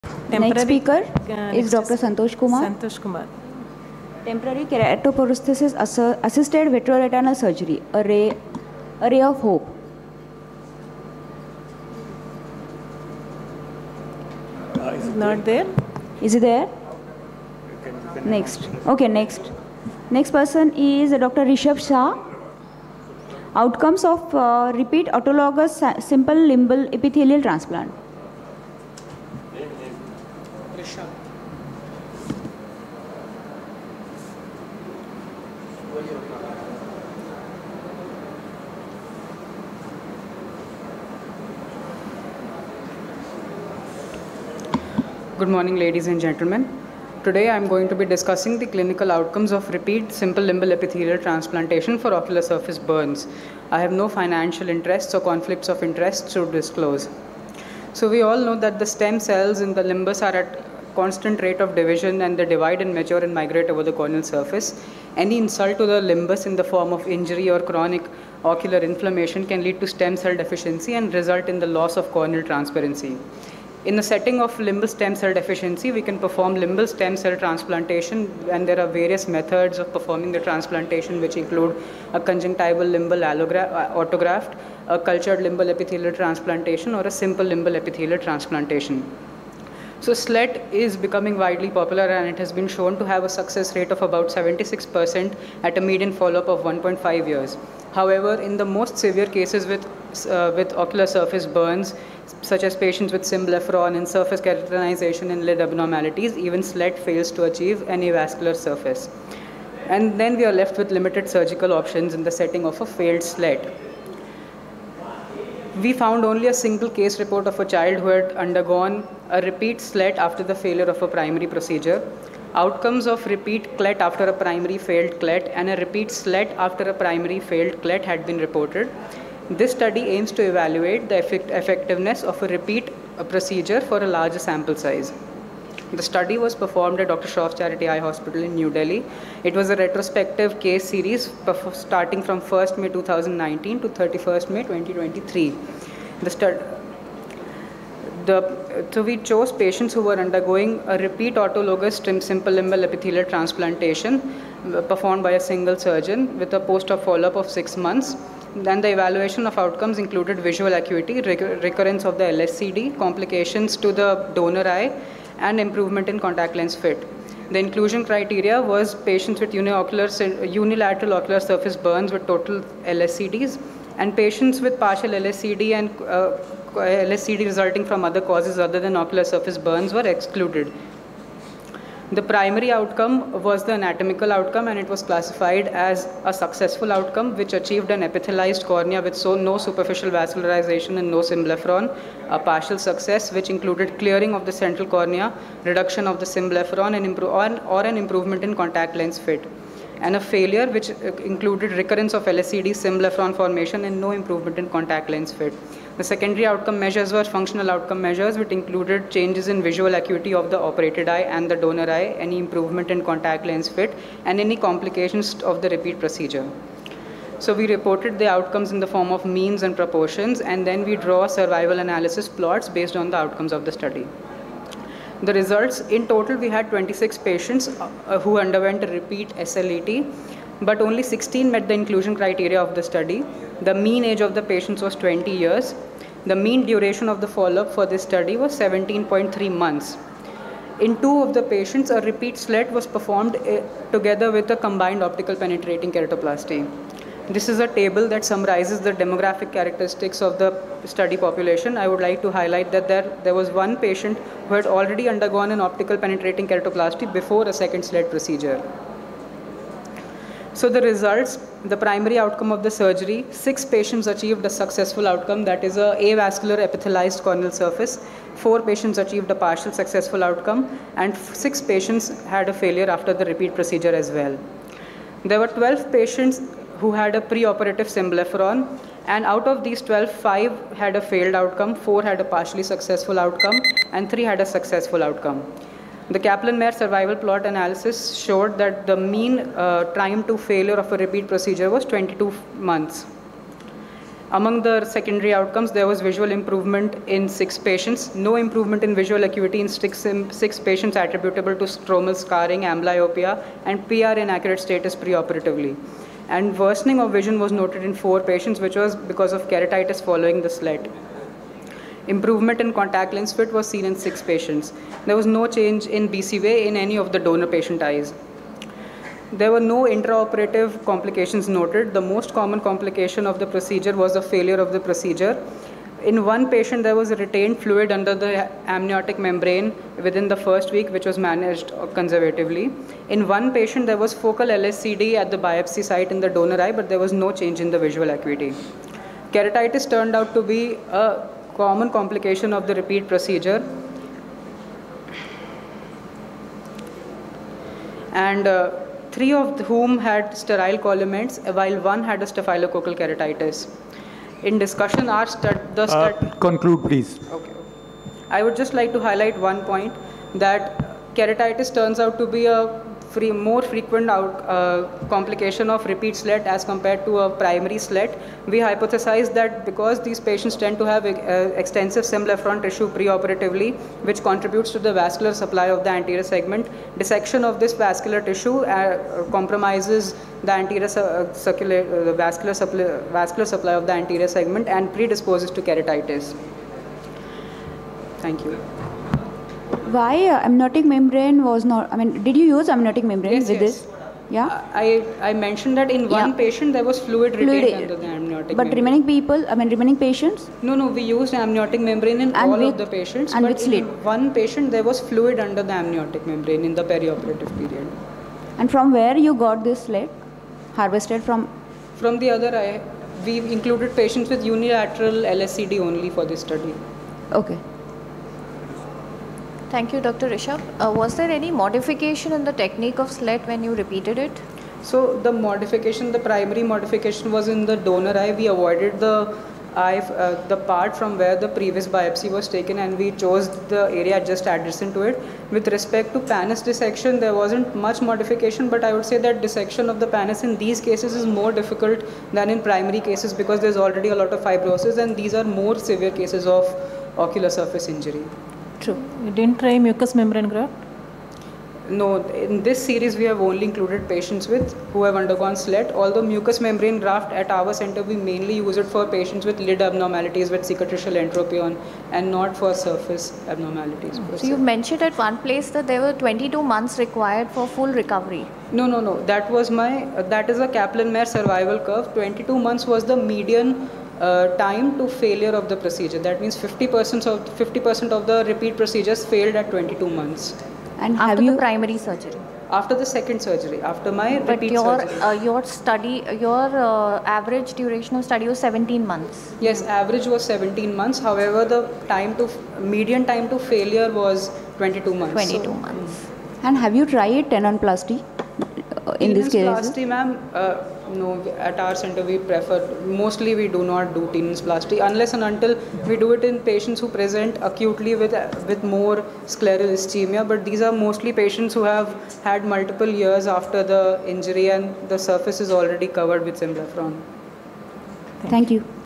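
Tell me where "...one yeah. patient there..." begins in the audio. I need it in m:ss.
6:36.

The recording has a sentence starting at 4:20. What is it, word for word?
So the results, the primary outcome of the surgery, six patients achieved a successful outcome, that is a avascular epithelized corneal surface.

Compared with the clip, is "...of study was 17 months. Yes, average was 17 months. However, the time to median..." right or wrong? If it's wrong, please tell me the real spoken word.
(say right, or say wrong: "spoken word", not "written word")
right.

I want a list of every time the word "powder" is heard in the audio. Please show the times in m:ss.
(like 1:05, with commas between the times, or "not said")
not said.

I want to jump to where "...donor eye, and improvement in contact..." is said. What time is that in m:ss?
2:44.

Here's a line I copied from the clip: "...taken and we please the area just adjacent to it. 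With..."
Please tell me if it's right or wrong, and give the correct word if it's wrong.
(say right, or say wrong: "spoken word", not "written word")
wrong: "chose", not "please".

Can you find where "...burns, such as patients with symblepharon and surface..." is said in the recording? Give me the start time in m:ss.
1:41.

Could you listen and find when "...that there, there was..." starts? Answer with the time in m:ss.
4:12.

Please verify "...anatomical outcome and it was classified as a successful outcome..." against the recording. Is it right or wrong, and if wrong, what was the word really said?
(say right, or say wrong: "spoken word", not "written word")
right.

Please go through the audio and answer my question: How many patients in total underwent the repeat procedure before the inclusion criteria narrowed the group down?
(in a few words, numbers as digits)
26.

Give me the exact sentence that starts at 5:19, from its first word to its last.
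There were no intraoperative complications noted.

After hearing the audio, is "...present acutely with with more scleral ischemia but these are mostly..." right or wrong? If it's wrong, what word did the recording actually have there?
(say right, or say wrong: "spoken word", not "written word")
right.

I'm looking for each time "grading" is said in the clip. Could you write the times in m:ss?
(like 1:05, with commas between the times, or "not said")
not said.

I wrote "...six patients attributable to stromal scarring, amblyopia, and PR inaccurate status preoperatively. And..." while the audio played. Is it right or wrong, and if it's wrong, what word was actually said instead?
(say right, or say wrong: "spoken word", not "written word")
right.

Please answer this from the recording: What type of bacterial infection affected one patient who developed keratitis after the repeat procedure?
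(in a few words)
Staphylococcal keratitis.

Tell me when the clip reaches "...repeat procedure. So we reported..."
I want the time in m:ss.
3:35.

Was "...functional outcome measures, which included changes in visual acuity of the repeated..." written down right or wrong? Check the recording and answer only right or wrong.
wrong.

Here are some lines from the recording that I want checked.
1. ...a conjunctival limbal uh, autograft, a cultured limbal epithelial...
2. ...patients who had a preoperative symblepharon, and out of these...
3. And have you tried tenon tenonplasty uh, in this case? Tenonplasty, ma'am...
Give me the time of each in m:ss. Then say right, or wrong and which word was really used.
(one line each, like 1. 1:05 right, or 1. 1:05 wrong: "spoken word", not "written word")
1. 1:22 right
2. 4:35 right
3. 8:16 right.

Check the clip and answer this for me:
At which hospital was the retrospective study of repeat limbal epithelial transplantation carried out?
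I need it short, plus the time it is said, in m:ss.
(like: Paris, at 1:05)
Dr. Shroff Charity Eye Hospital, at 2:17.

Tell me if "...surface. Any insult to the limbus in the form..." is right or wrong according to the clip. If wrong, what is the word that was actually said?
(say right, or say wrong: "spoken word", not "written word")
right.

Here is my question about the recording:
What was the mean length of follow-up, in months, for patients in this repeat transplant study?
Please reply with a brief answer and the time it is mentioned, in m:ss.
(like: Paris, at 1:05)
17.3 months, at 3:58.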